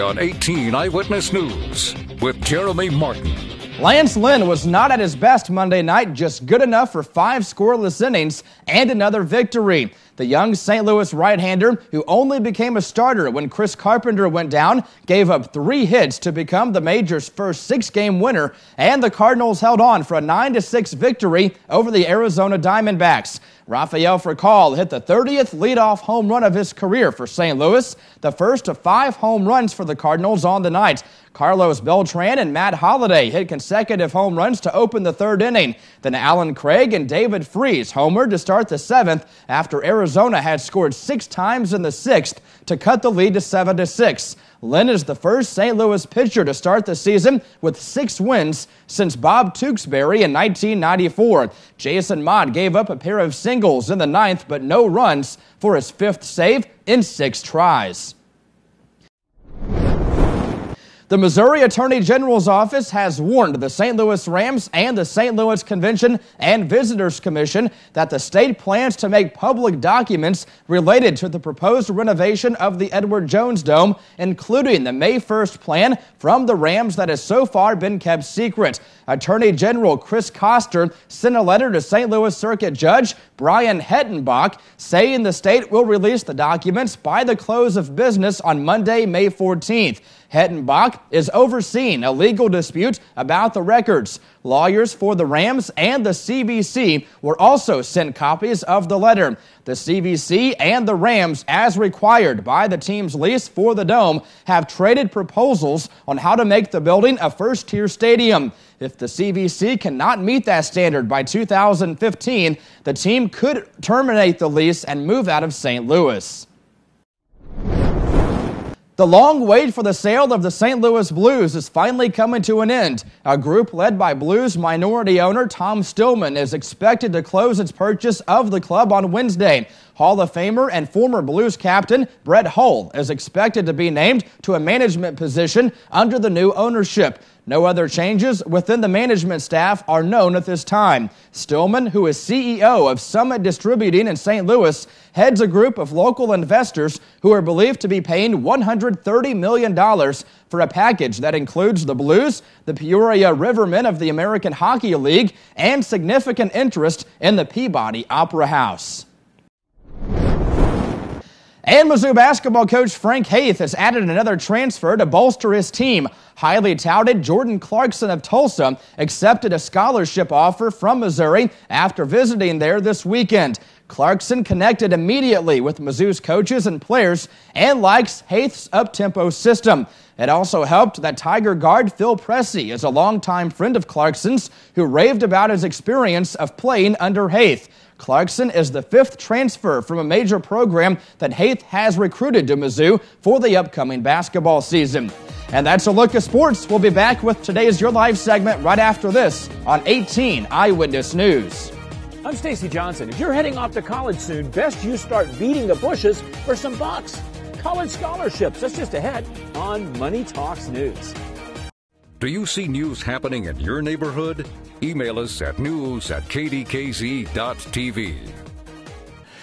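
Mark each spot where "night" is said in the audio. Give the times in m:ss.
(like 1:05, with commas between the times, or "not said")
0:05, 0:30.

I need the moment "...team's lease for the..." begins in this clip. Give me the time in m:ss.
1:42.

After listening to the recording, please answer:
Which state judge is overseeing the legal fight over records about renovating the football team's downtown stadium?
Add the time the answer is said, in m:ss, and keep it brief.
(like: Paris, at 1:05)
Brian Hettenbach, at 1:23.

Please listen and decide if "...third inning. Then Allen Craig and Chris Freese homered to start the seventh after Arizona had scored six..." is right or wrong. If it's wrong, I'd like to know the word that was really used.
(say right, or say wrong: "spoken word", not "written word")
wrong: "David", not "Chris".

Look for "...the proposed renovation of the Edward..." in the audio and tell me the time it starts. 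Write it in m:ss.
1:11.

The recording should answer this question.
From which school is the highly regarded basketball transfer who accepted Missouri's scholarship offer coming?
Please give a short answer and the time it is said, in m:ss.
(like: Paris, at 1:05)
Tulsa, at 2:48.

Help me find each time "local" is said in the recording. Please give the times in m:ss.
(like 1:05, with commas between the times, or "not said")
2:25.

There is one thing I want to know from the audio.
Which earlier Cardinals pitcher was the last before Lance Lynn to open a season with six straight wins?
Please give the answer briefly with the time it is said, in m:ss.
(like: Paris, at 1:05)
Bob Tewksbury, at 0:49.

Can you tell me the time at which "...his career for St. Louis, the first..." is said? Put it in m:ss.
0:26.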